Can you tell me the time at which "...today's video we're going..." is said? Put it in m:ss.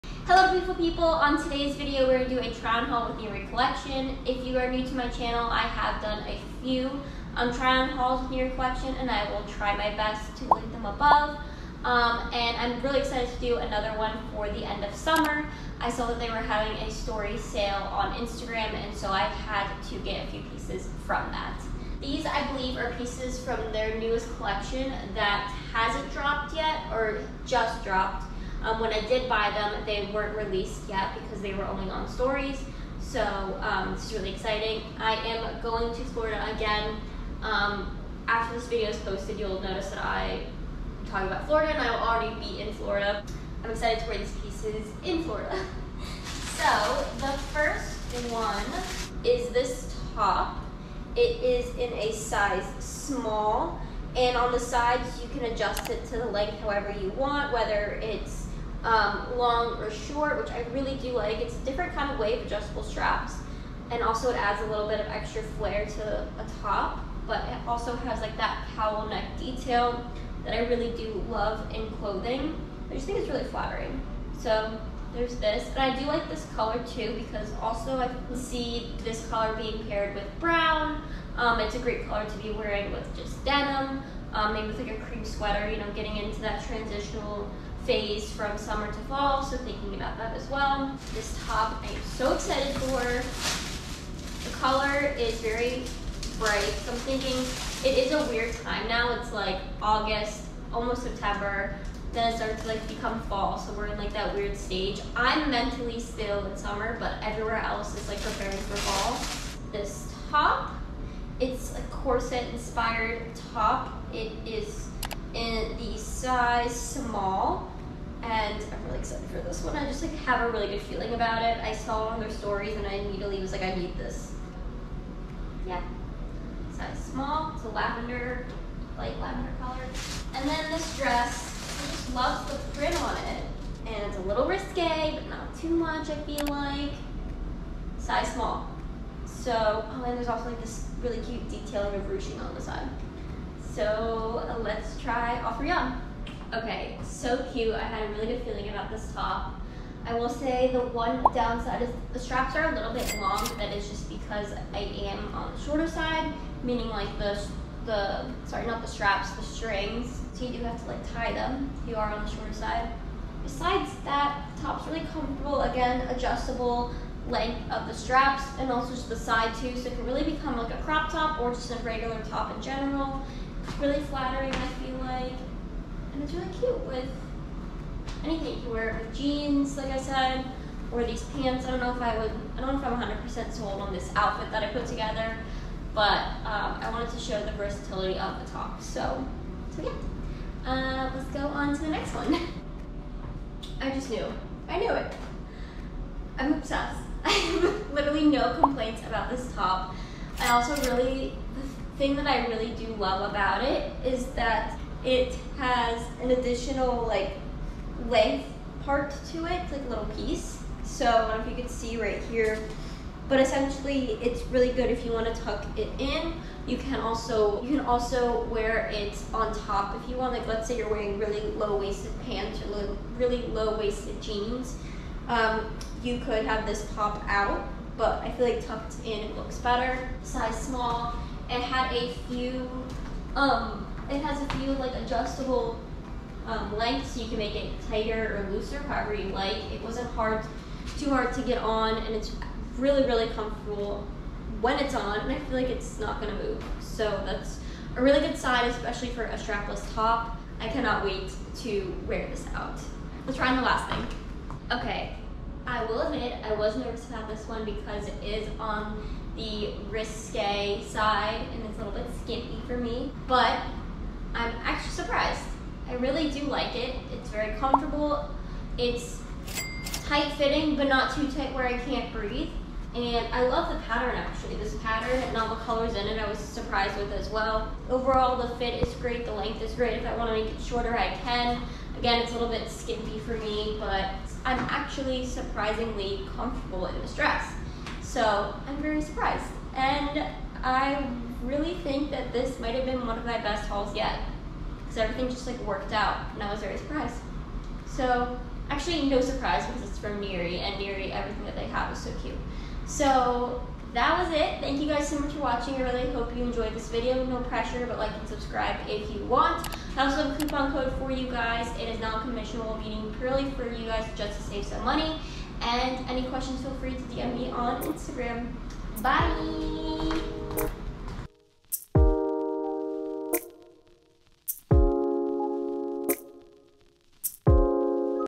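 0:01.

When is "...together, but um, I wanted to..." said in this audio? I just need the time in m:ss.
3:04.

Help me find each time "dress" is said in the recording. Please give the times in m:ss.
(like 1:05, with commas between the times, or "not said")
2:10, 4:47.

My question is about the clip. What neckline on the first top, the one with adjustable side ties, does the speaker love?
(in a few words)
Cowl neck.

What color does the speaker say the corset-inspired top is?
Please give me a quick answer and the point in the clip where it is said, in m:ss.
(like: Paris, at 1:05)
Light lavender, at 2:08.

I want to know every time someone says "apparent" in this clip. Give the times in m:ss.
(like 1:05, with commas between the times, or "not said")
not said.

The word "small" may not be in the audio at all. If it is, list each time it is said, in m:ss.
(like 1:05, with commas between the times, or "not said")
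0:52, 1:56, 2:06, 2:18, 3:50.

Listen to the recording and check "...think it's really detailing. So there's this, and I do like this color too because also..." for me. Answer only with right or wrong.
wrong.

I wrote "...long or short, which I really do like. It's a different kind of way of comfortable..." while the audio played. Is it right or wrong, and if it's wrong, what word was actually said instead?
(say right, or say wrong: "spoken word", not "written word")
wrong: "adjustable", not "comfortable".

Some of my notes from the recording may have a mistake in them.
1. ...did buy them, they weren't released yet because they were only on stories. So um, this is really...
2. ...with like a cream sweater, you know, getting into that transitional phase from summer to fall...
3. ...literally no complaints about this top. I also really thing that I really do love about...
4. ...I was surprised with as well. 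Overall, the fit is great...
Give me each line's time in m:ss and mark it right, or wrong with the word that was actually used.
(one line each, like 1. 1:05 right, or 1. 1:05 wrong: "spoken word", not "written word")
1. 0:29 right
2. 1:24 right
3. 3:17 right
4. 4:36 right.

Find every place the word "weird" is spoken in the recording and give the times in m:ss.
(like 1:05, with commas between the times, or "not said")
1:38, 1:44.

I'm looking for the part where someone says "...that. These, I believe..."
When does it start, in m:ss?
0:21.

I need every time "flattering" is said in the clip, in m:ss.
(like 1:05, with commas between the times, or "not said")
1:13, 2:54.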